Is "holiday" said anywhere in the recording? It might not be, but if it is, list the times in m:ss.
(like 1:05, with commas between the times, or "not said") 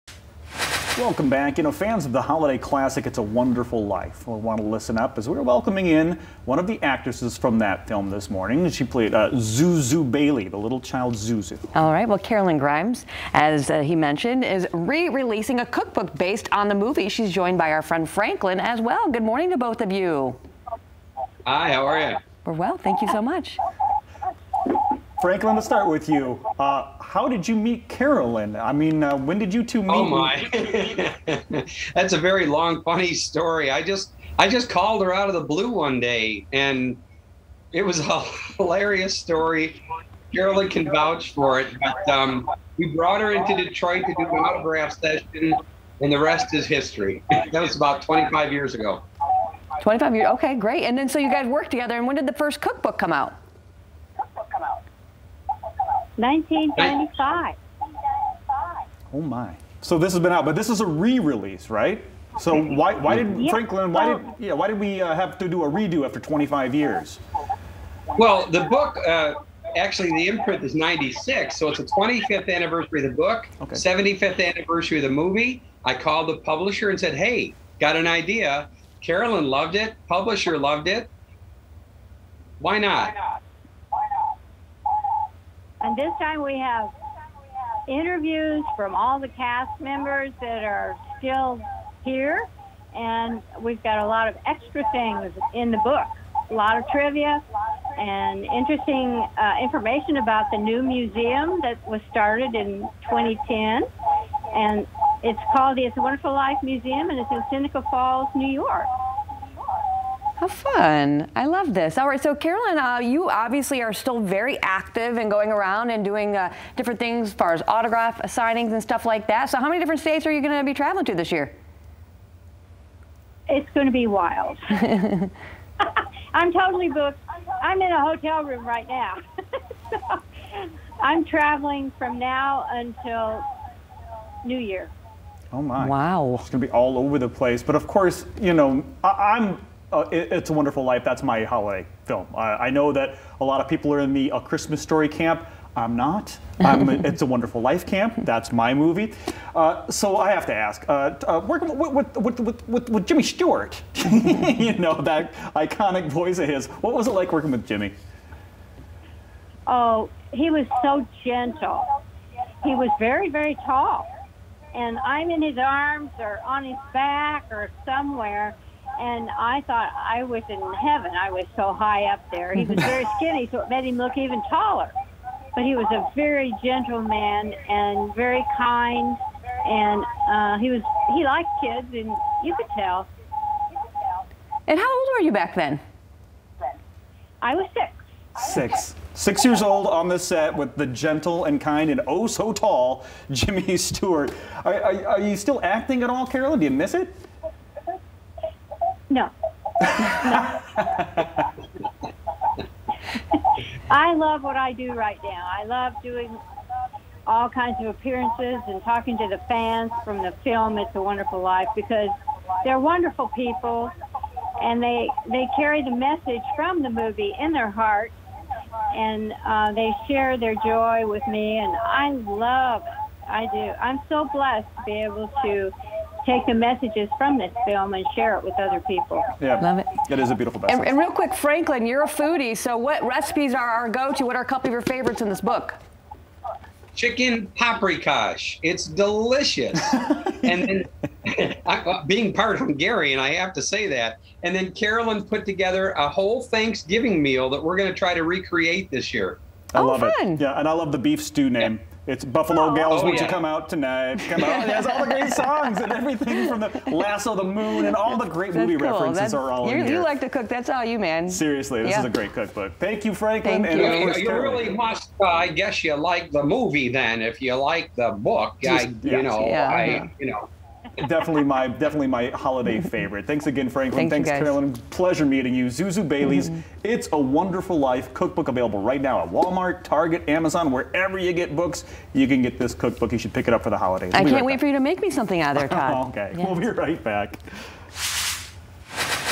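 0:02, 2:21, 4:32, 4:43.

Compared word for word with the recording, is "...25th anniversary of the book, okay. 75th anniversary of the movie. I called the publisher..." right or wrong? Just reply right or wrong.
right.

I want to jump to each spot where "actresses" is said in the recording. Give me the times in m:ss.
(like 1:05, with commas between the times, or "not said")
0:06.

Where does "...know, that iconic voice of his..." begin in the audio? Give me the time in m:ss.
2:34.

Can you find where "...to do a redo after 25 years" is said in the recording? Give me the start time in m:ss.
1:05.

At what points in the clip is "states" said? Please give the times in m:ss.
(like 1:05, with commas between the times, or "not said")
2:00.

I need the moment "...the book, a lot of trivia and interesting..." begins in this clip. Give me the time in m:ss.
1:35.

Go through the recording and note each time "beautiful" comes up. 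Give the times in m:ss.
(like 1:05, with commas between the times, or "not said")
3:50.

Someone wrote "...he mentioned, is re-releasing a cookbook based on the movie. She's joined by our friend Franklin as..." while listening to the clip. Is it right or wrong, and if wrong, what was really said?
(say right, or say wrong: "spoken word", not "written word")
right.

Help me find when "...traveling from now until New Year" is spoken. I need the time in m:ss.
2:11.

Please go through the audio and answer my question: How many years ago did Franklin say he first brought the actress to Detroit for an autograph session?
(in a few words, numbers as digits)
25.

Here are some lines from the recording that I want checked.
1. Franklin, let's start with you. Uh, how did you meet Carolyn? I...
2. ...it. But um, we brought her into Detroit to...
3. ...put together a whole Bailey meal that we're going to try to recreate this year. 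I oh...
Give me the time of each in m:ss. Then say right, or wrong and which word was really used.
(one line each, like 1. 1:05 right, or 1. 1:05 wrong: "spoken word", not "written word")
1. 0:25 right
2. 0:41 right
3. 4:05 wrong: "Thanksgiving", not "Bailey".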